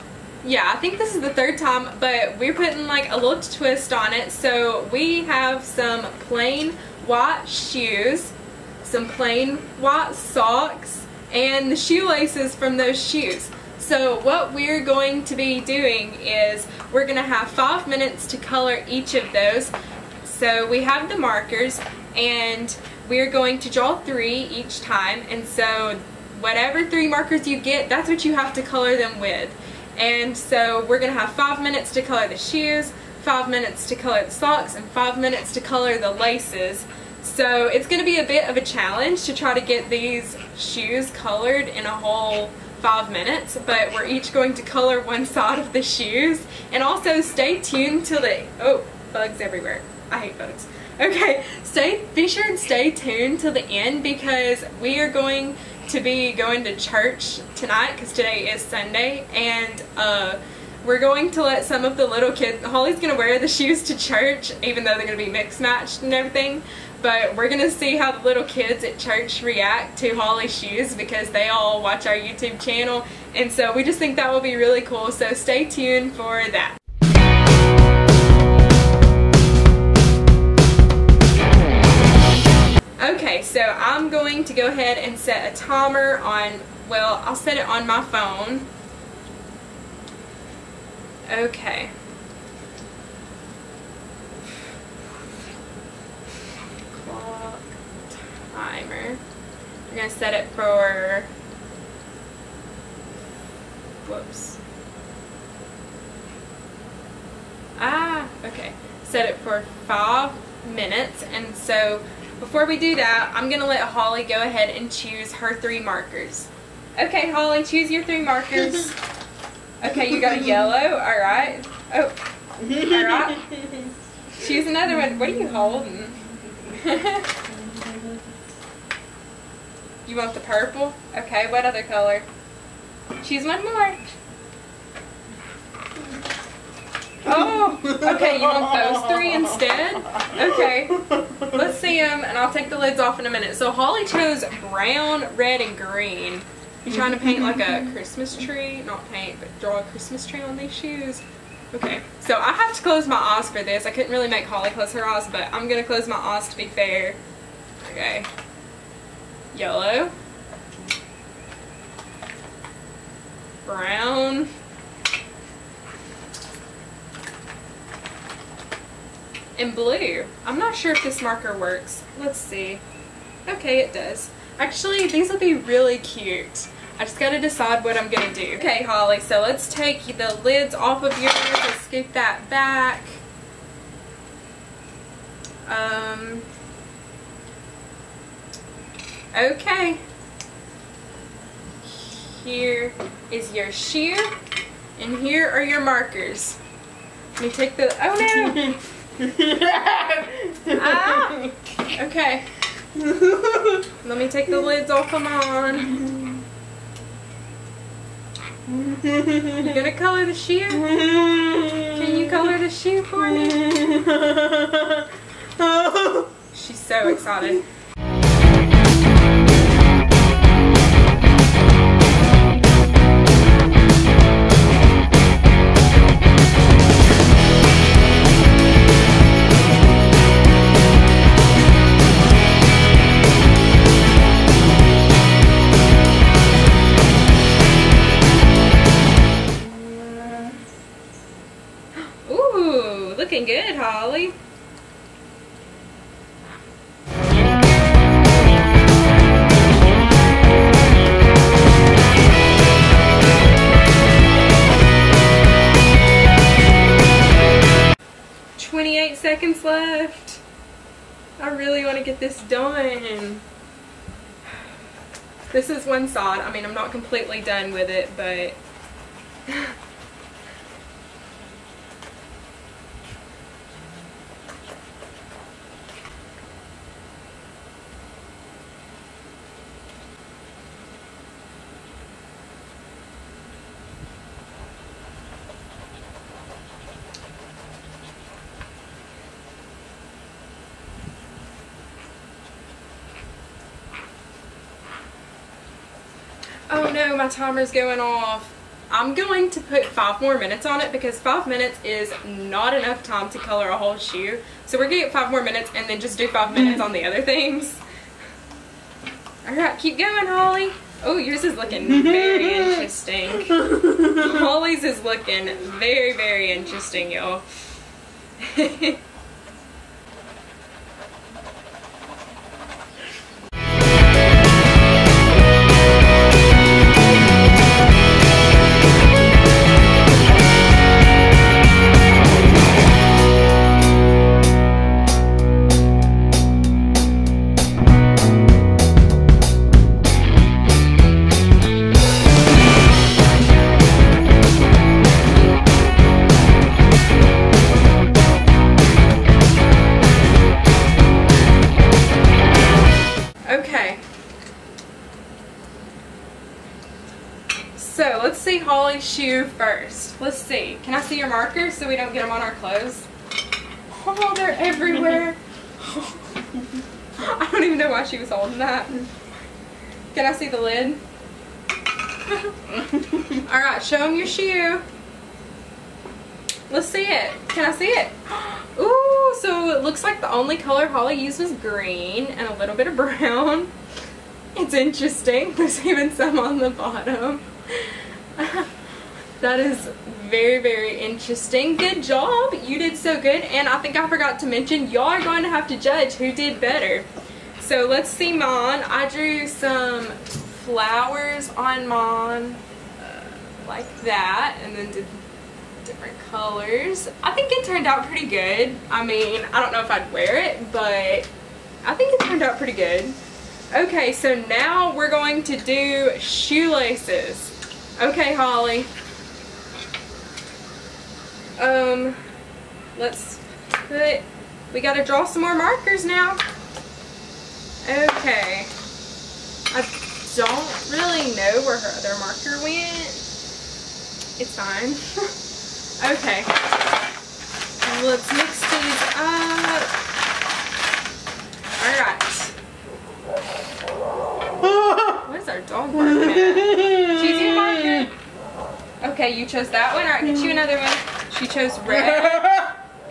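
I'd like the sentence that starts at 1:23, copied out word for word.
Okay, so I'm going to go ahead and set a timer on, well, I'll set it on my phone.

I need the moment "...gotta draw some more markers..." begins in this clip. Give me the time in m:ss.
7:04.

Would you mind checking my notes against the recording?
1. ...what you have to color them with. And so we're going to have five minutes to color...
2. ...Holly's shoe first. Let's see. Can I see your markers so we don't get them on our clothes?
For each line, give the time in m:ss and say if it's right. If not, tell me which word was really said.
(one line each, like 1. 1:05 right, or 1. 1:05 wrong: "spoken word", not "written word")
1. 0:28 right
2. 5:58 right.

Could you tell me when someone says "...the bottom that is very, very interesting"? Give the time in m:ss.
6:26.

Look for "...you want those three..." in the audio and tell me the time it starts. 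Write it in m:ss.
2:18.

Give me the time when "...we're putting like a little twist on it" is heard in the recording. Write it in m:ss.
0:02.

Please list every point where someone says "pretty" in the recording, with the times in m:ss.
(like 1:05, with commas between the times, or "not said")
6:48, 6:52.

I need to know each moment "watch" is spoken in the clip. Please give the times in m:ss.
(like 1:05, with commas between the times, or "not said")
1:11.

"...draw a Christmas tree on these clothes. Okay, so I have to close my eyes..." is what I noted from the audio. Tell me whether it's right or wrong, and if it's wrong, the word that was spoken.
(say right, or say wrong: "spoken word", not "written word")
wrong: "shoes", not "clothes".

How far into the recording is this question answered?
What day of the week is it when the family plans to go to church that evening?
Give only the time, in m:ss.
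0:58.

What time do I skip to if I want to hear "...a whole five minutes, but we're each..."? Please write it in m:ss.
0:41.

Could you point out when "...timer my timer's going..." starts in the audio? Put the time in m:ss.
4:57.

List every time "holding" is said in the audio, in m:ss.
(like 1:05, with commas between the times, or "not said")
2:05, 6:08.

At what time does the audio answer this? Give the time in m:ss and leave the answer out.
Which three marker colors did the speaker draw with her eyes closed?
2:39.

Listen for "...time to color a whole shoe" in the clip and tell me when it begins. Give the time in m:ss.
5:03.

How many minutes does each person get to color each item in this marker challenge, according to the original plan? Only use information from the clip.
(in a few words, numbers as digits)
5.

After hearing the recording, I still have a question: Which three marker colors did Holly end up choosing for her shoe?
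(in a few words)
Brown, red, and green.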